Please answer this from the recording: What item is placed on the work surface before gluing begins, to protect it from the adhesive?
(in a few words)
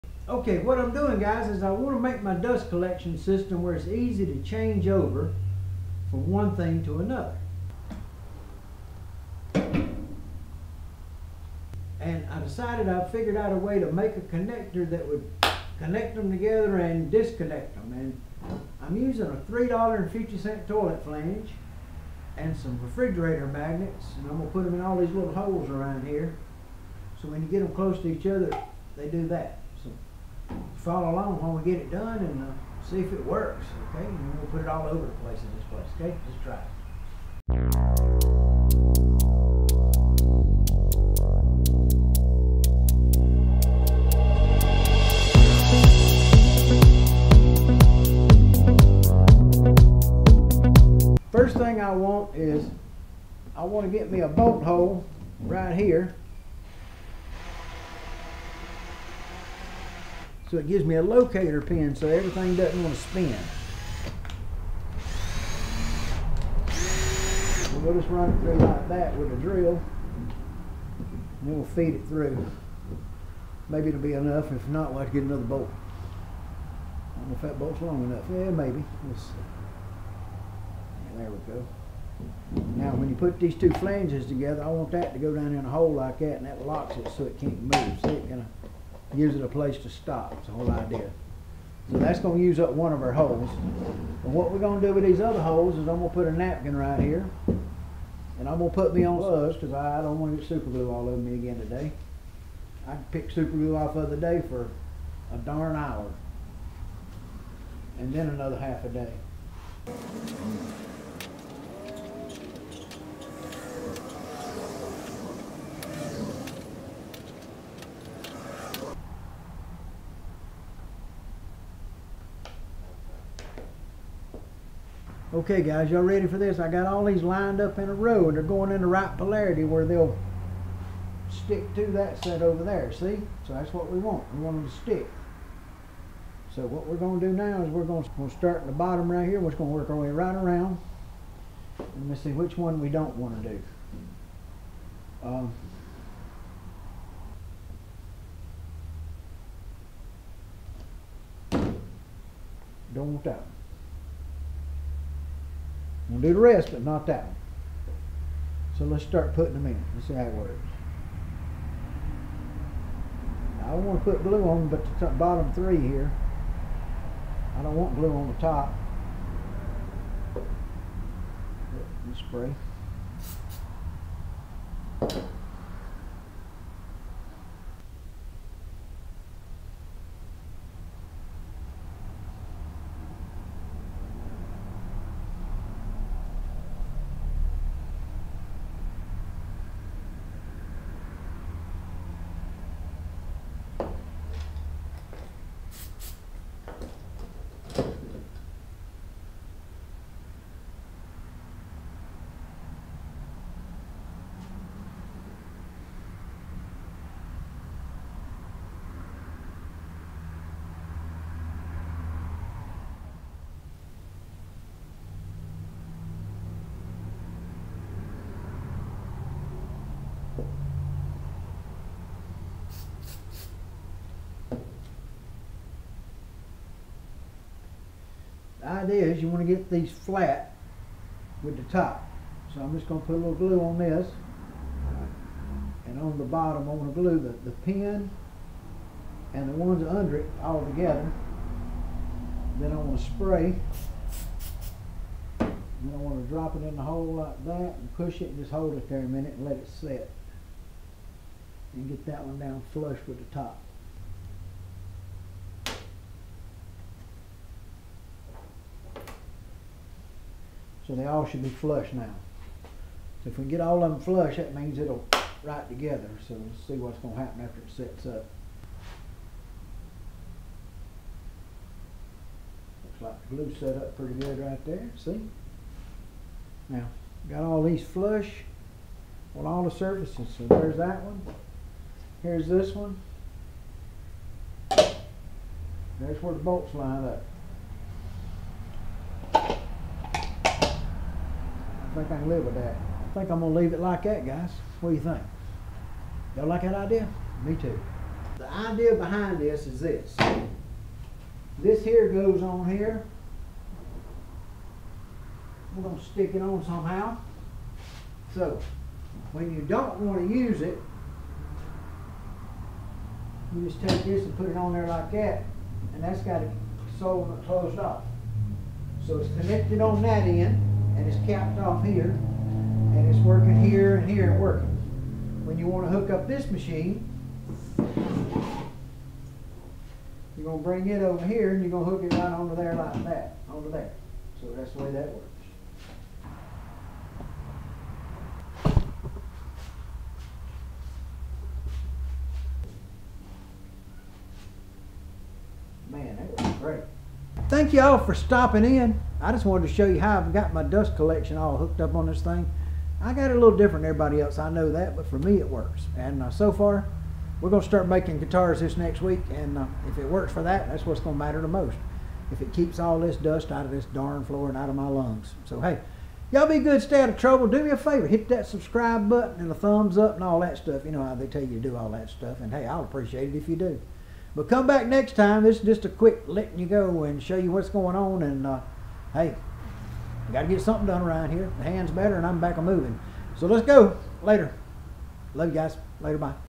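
a napkin.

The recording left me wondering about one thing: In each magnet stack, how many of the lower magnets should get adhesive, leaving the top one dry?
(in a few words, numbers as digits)
3.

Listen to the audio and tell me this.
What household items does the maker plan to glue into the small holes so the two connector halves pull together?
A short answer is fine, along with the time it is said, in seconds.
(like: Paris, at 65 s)
refrigerator magnets, at 22 s.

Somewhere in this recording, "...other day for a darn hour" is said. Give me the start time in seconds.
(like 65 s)
104 s.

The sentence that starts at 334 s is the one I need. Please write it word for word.
So that's the way that works.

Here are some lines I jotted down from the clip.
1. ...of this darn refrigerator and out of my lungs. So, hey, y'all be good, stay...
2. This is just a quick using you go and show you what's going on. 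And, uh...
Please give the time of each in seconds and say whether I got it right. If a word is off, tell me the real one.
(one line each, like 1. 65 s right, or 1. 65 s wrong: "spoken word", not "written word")
1. 363 s wrong: "floor", not "refrigerator"
2. 375 s wrong: "letting", not "using".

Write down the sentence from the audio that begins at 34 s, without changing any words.
And we'll put it all over the place in this place, okay?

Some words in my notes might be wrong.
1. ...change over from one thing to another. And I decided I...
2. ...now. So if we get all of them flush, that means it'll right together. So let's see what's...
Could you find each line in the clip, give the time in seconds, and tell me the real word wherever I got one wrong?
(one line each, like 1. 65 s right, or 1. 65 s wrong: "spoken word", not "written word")
1. 4 s right
2. 261 s right.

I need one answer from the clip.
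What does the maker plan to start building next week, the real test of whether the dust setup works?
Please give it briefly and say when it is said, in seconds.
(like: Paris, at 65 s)
guitars, at 358 s.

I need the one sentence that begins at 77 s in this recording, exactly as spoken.
I don't know if that bolt's long enough.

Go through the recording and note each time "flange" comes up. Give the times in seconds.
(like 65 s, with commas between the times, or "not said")
21 s, 83 s.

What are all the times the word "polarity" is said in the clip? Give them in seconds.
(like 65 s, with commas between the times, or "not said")
129 s.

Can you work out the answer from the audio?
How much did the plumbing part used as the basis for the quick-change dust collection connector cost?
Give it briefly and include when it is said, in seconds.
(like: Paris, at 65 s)
$3.50, at 19 s.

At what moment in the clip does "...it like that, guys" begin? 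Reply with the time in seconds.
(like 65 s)
293 s.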